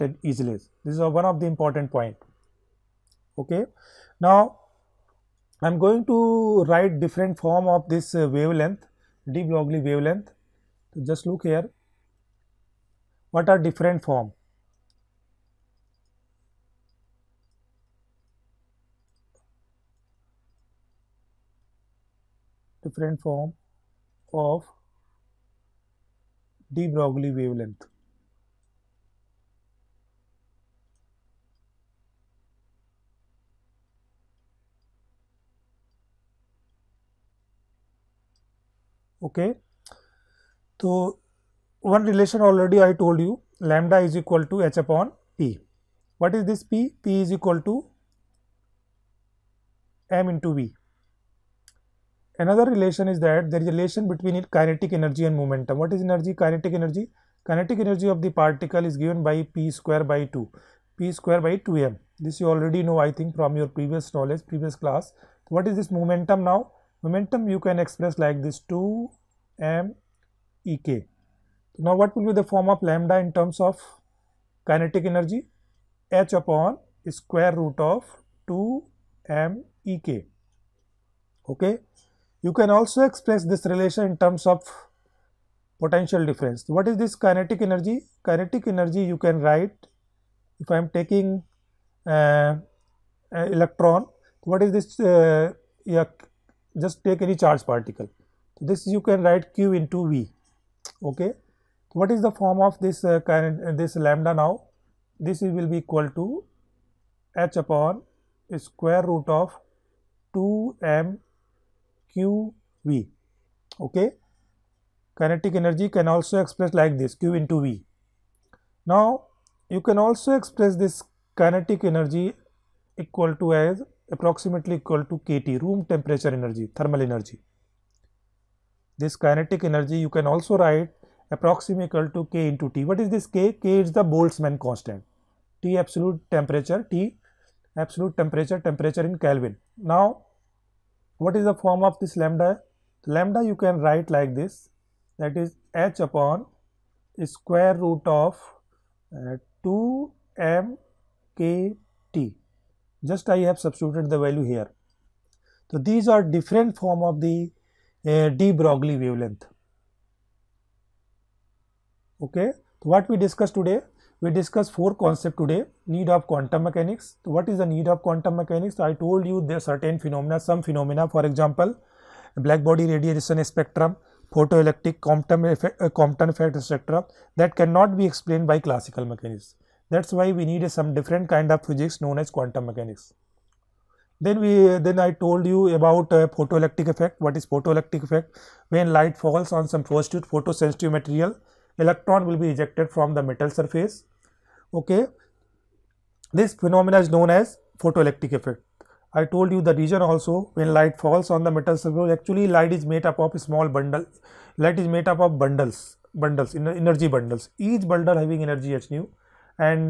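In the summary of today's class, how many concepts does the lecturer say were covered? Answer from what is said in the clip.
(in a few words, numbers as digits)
4.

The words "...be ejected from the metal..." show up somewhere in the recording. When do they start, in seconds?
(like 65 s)
192 s.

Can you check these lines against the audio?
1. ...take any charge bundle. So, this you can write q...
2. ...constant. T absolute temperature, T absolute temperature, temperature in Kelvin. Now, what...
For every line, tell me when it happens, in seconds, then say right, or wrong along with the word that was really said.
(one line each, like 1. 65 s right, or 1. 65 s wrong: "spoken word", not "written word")
1. 97 s wrong: "particle", not "bundle"
2. 134 s right.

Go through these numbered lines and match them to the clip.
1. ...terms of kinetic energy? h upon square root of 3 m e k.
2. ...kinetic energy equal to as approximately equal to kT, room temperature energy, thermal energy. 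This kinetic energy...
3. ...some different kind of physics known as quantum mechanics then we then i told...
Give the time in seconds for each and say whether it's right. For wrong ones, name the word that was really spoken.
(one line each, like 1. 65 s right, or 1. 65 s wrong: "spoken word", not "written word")
1. 73 s wrong: "2", not "3"
2. 121 s right
3. 180 s right.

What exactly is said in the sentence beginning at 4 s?
Now, I am going to write different form of this uh, wavelength de Broglie wavelength.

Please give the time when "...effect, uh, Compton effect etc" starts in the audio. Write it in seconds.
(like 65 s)
175 s.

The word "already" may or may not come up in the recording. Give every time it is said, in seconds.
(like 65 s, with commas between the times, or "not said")
42 s, 62 s.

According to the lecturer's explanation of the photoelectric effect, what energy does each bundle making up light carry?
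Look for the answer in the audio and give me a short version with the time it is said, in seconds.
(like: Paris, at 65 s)
h nu, at 208 s.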